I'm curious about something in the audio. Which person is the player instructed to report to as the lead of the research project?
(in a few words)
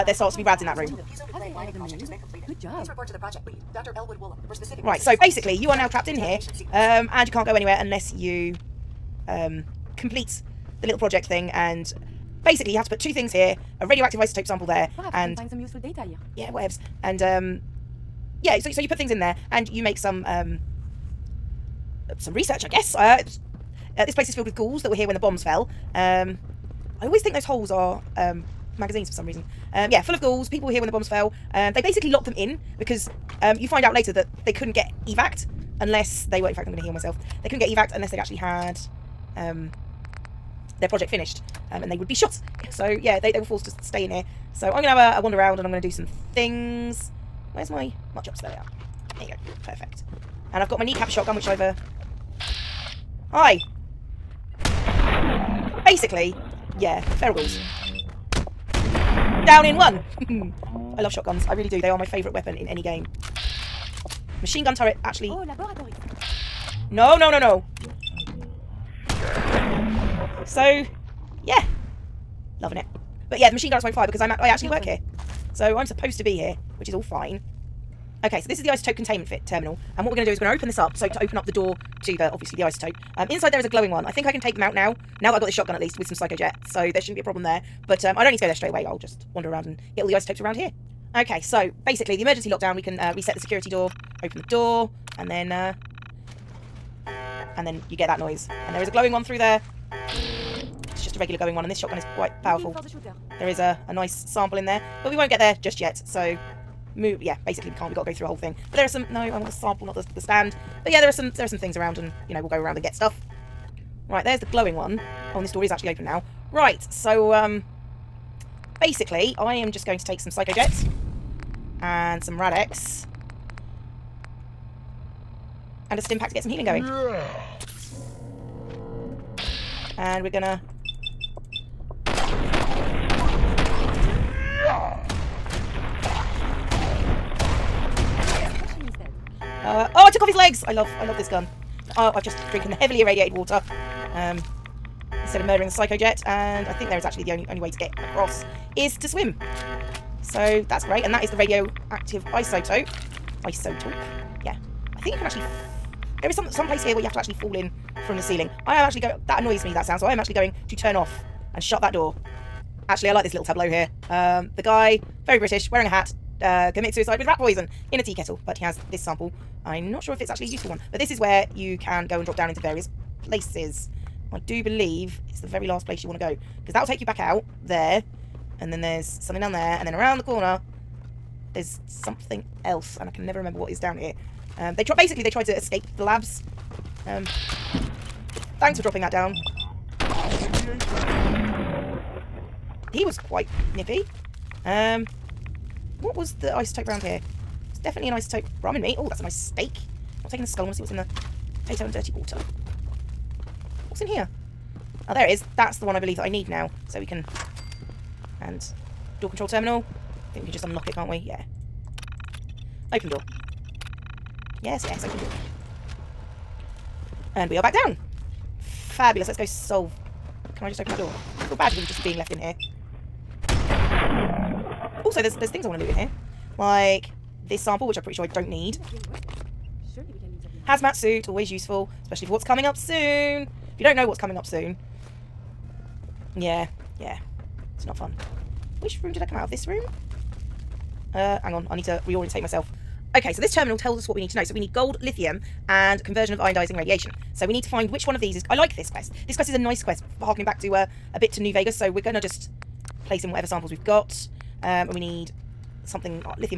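Dr. Elwood Woolham.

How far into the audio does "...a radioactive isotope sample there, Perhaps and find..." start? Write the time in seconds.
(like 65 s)
13 s.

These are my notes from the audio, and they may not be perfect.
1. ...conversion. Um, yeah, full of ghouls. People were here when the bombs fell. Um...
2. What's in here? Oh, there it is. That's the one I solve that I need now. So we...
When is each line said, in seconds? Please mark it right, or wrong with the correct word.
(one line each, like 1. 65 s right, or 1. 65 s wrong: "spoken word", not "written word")
1. 29 s wrong: "reason", not "conversion"
2. 203 s wrong: "believe", not "solve".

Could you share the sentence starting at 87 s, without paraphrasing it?
But um, I don't need to go there straight away.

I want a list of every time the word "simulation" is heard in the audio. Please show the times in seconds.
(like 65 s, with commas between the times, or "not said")
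not said.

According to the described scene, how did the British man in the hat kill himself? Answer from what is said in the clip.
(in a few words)
Rat poison in a tea kettle.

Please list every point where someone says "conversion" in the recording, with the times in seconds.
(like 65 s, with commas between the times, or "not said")
246 s.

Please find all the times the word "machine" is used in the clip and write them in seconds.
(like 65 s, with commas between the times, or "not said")
64 s, 73 s.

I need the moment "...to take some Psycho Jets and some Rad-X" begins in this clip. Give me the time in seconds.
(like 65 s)
119 s.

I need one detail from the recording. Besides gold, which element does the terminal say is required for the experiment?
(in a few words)
Lithium.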